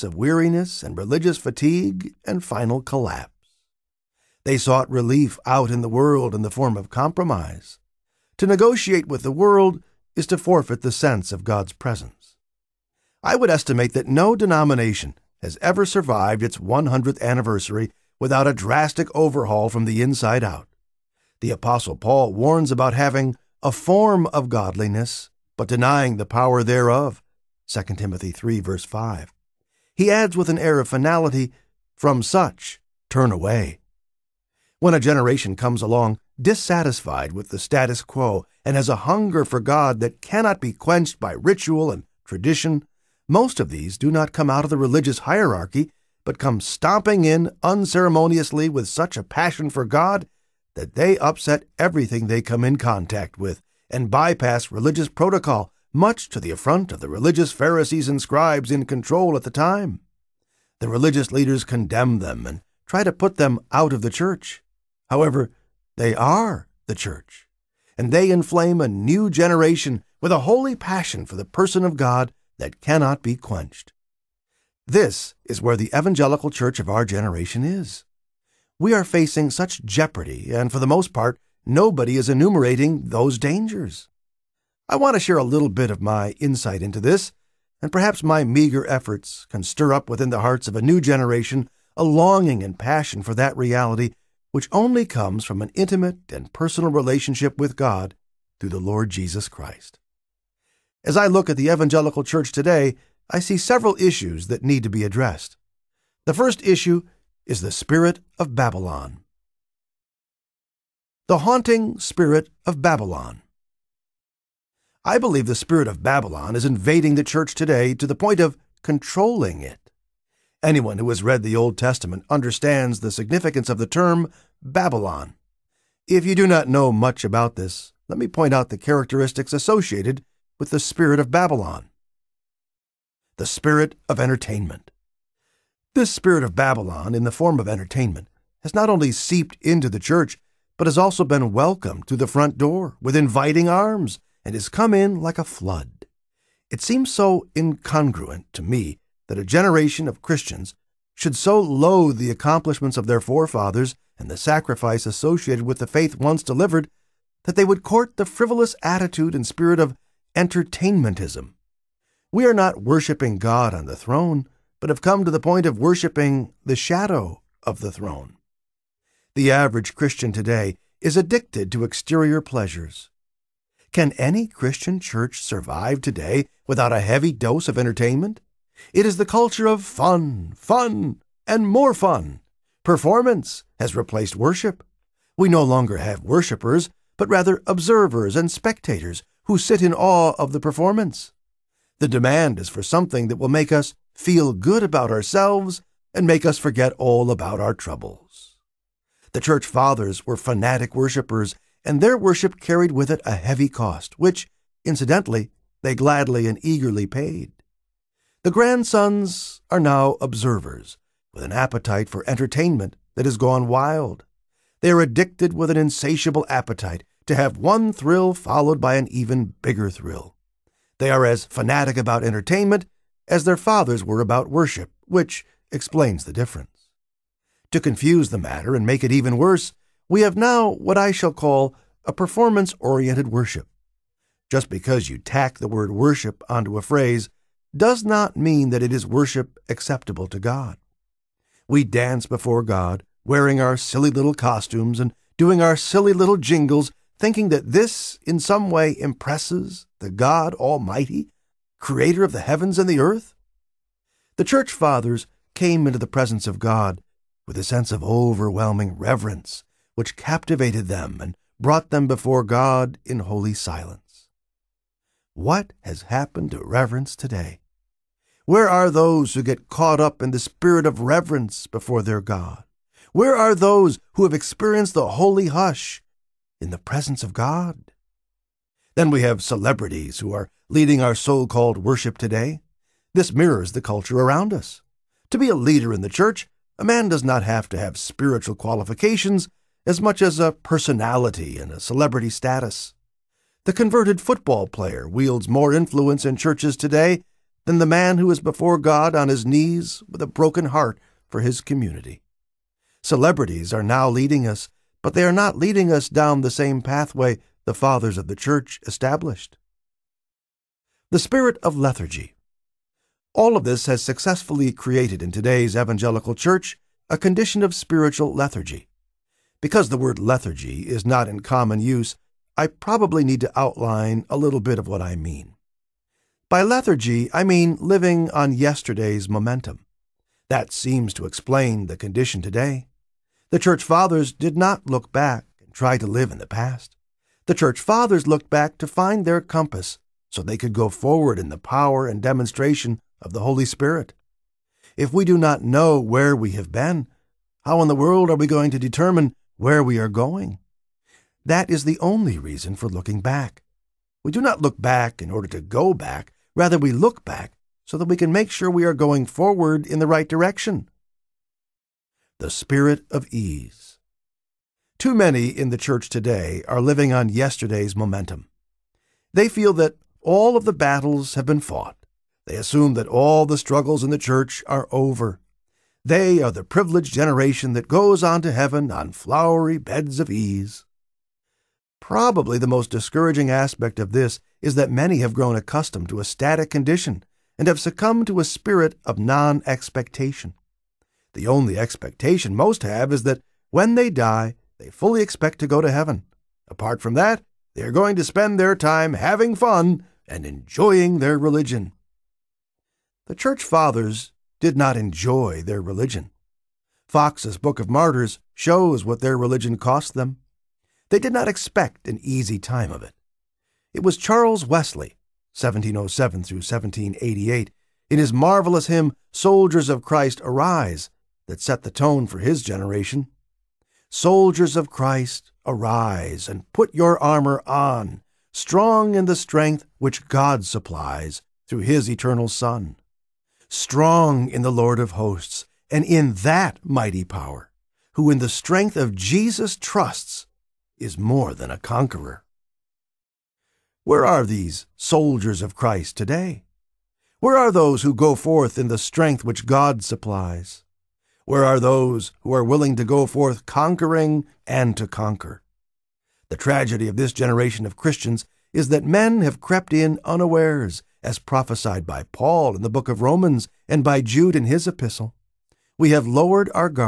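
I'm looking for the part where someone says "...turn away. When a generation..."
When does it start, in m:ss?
0:33.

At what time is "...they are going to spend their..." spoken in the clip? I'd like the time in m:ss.
6:37.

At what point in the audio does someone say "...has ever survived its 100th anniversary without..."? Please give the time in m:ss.
0:15.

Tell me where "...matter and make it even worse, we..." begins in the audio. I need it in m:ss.
3:48.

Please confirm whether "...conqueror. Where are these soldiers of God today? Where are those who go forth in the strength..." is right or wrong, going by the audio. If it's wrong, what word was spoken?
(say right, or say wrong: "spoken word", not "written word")
wrong: "Christ", not "God".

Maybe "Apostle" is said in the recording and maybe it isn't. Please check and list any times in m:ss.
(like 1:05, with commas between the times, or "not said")
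0:21.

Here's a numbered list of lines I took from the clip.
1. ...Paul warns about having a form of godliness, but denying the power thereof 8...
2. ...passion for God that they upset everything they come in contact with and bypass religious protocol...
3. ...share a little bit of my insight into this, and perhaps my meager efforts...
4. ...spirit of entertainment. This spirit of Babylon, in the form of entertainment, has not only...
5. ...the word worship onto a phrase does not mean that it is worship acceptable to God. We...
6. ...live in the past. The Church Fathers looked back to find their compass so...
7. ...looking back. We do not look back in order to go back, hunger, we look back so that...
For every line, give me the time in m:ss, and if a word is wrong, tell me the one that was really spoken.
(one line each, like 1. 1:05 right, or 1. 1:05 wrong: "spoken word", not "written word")
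1. 0:21 wrong: "2", not "8"
2. 0:49 right
3. 1:25 right
4. 2:13 right
5. 3:55 right
6. 5:36 right
7. 5:52 wrong: "rather", not "hunger".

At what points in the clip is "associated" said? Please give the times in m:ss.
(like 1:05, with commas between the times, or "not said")
2:09, 2:35.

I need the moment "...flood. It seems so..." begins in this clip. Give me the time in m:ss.
2:25.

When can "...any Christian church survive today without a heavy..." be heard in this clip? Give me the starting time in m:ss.
2:54.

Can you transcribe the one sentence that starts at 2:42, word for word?
We are not worshiping God on the throne, but have come to the point of worshiping the shadow of the throne.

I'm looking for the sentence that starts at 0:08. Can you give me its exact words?
To negotiate with the world is to forfeit the sense of God's presence.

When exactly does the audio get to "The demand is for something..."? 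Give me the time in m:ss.
3:11.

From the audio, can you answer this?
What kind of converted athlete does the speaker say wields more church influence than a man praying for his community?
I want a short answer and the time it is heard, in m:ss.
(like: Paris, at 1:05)
Football player, at 4:54.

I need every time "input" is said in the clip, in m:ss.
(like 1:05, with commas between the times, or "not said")
not said.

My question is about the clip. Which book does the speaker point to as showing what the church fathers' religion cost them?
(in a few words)
Fox's Book of Martyrs.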